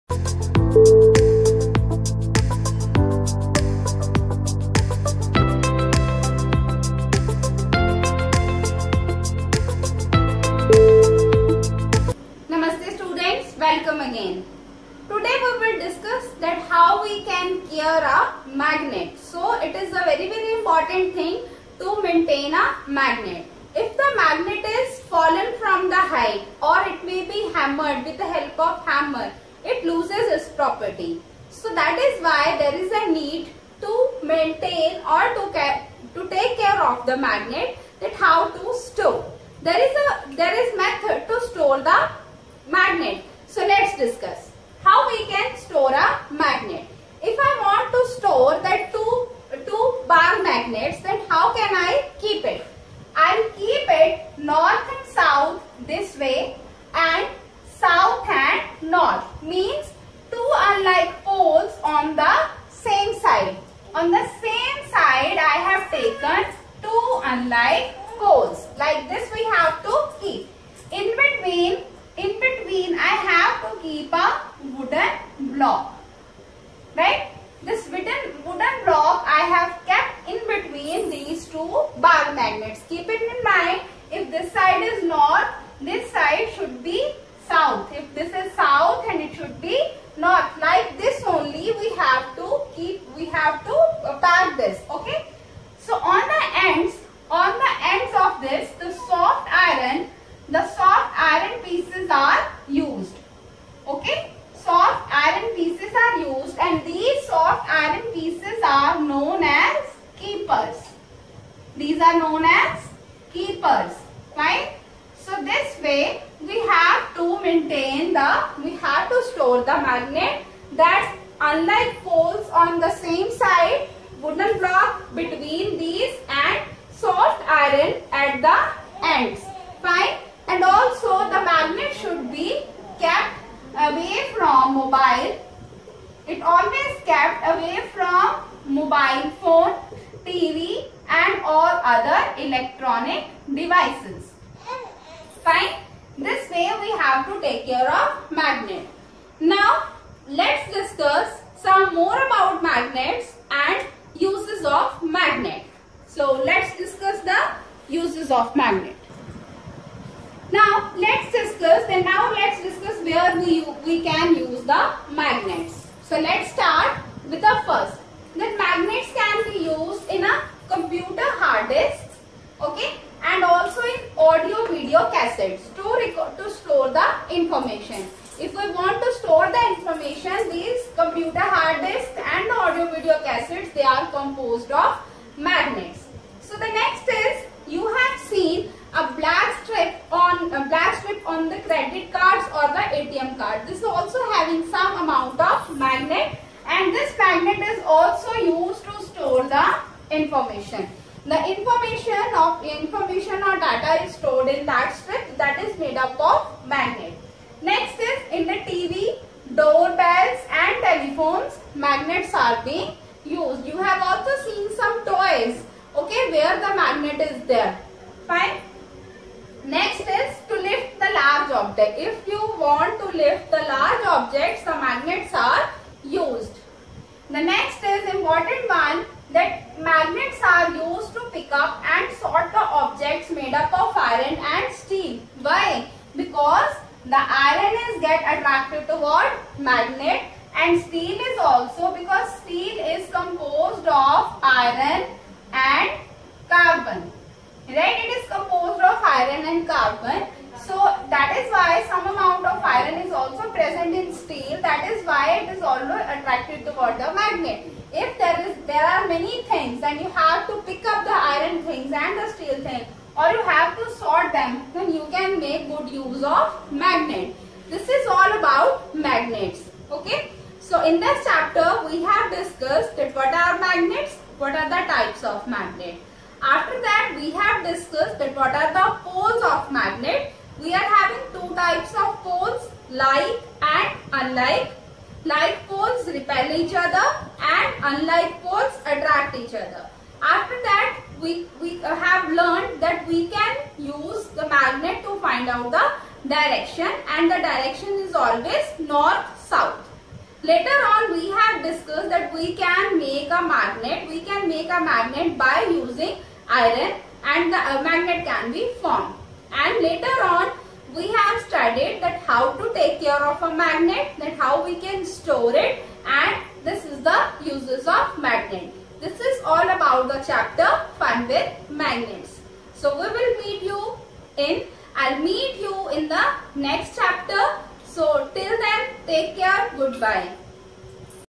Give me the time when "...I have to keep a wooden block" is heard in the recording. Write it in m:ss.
1:13.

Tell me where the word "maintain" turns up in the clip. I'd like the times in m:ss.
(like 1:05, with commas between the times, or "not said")
0:22, 0:34, 1:57.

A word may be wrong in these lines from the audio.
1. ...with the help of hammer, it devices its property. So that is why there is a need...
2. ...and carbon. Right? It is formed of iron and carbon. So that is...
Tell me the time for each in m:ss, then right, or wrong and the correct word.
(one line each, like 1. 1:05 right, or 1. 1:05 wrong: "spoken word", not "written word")
1. 0:28 wrong: "loses", not "devices"
2. 4:05 wrong: "composed", not "formed".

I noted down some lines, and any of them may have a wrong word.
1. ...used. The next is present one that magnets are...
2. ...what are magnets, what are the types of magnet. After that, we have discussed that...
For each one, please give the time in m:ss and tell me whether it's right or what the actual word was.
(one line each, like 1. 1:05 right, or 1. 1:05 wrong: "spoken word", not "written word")
1. 3:46 wrong: "important", not "present"
2. 4:33 right.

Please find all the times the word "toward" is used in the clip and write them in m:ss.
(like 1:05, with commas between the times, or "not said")
3:58, 4:16.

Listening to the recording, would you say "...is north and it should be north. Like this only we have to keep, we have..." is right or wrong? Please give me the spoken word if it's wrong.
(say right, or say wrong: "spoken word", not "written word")
wrong: "south", not "north".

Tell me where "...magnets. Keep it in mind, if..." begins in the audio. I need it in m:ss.
1:22.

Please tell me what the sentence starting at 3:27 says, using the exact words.
Next is in the TV, doorbells and telephones, magnets are being used.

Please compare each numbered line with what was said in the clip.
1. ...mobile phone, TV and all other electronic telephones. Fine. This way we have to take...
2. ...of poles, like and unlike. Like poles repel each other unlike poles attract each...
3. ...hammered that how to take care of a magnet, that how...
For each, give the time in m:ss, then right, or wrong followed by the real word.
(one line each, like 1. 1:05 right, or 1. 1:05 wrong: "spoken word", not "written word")
1. 2:18 wrong: "devices", not "telephones"
2. 4:41 right
3. 5:11 wrong: "studied", not "hammered".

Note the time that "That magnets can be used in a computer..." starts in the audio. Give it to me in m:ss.
2:48.